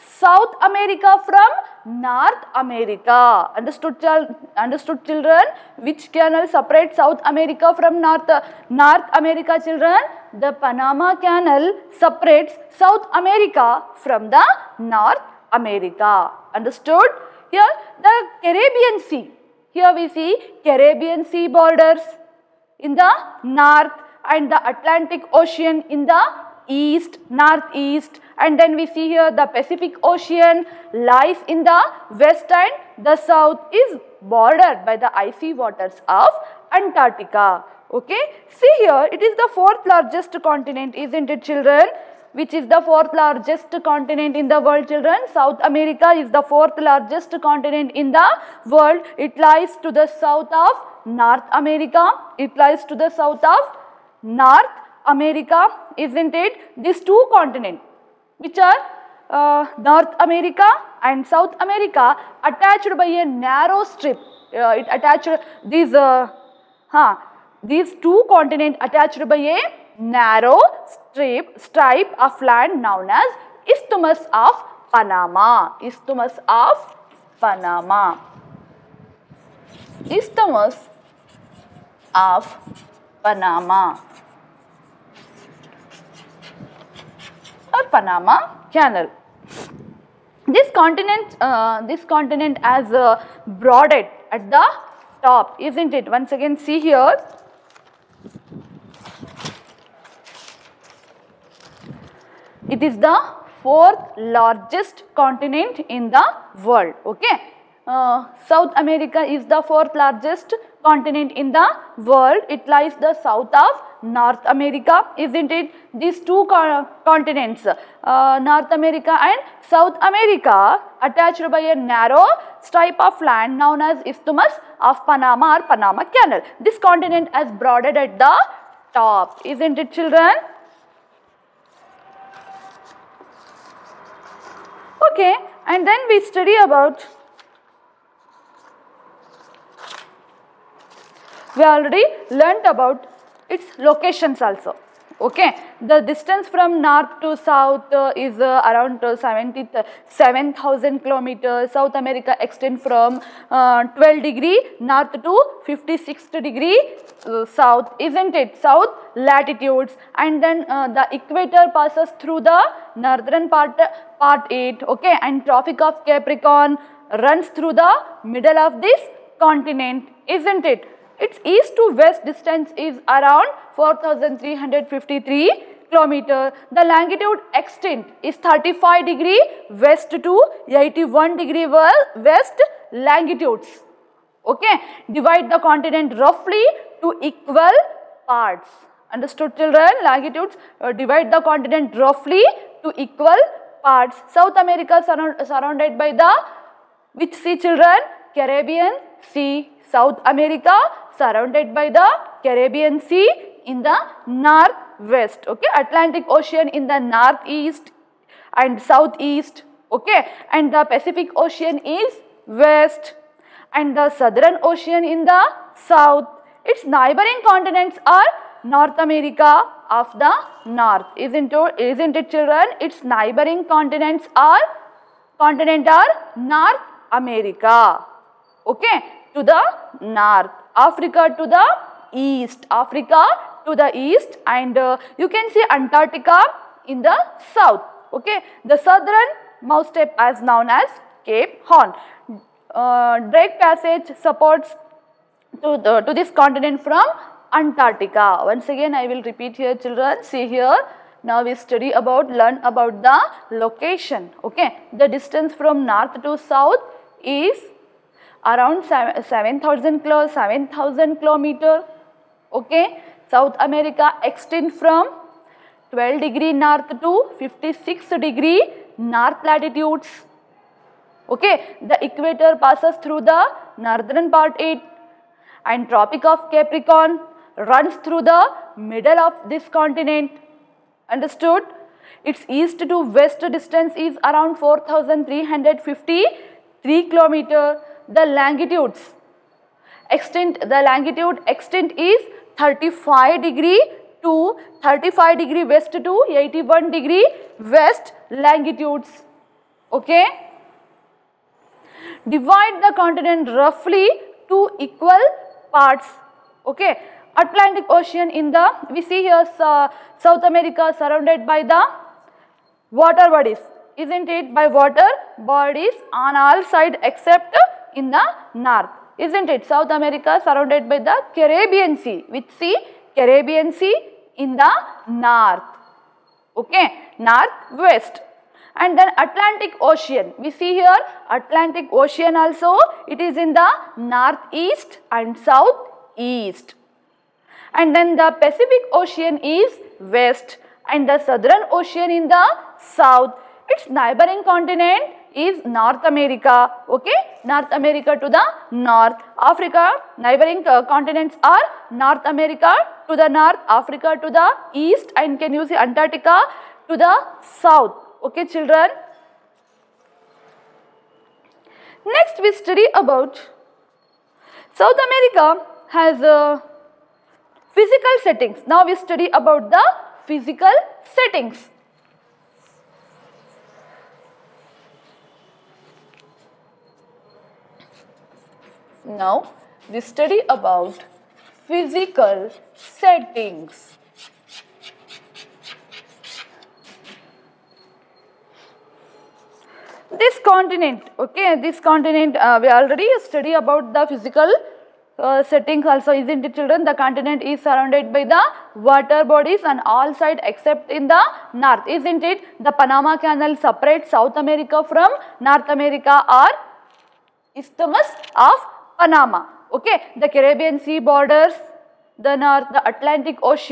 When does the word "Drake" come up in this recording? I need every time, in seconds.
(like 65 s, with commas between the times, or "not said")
243 s.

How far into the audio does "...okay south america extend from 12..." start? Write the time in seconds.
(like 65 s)
262 s.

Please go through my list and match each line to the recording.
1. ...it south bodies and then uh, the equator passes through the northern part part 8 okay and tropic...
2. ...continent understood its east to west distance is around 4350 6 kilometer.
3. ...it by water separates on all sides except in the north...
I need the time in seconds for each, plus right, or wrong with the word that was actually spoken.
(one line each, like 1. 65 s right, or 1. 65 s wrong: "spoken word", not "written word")
1. 158 s wrong: "latitudes", not "bodies"
2. 279 s wrong: "3", not "6"
3. 314 s wrong: "bodies", not "separates".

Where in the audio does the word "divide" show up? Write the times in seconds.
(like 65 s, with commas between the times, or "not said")
185 s, 190 s, 302 s.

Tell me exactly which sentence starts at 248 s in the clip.
Once again I will repeat here children, see here now we study about, learn about the location, okay.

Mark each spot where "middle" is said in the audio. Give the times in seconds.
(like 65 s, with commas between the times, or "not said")
168 s, 278 s.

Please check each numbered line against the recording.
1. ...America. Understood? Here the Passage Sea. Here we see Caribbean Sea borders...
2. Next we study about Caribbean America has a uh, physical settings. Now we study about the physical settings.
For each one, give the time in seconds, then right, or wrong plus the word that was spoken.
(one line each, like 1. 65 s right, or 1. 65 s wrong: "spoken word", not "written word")
1. 15 s wrong: "Caribbean", not "Passage"
2. 362 s wrong: "South", not "Caribbean".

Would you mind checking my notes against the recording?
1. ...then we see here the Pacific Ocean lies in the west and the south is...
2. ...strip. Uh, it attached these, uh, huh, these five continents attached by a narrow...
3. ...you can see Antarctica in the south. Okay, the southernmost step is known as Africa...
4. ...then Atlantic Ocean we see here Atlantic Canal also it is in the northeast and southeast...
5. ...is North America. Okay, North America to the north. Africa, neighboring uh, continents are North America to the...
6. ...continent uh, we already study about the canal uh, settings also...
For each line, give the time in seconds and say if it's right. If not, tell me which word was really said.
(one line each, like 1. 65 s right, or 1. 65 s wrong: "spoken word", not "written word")
1. 28 s right
2. 63 s wrong: "two", not "five"
3. 235 s wrong: "Cape", not "Africa"
4. 328 s wrong: "Ocean", not "Canal"
5. 345 s right
6. 391 s wrong: "physical", not "canal".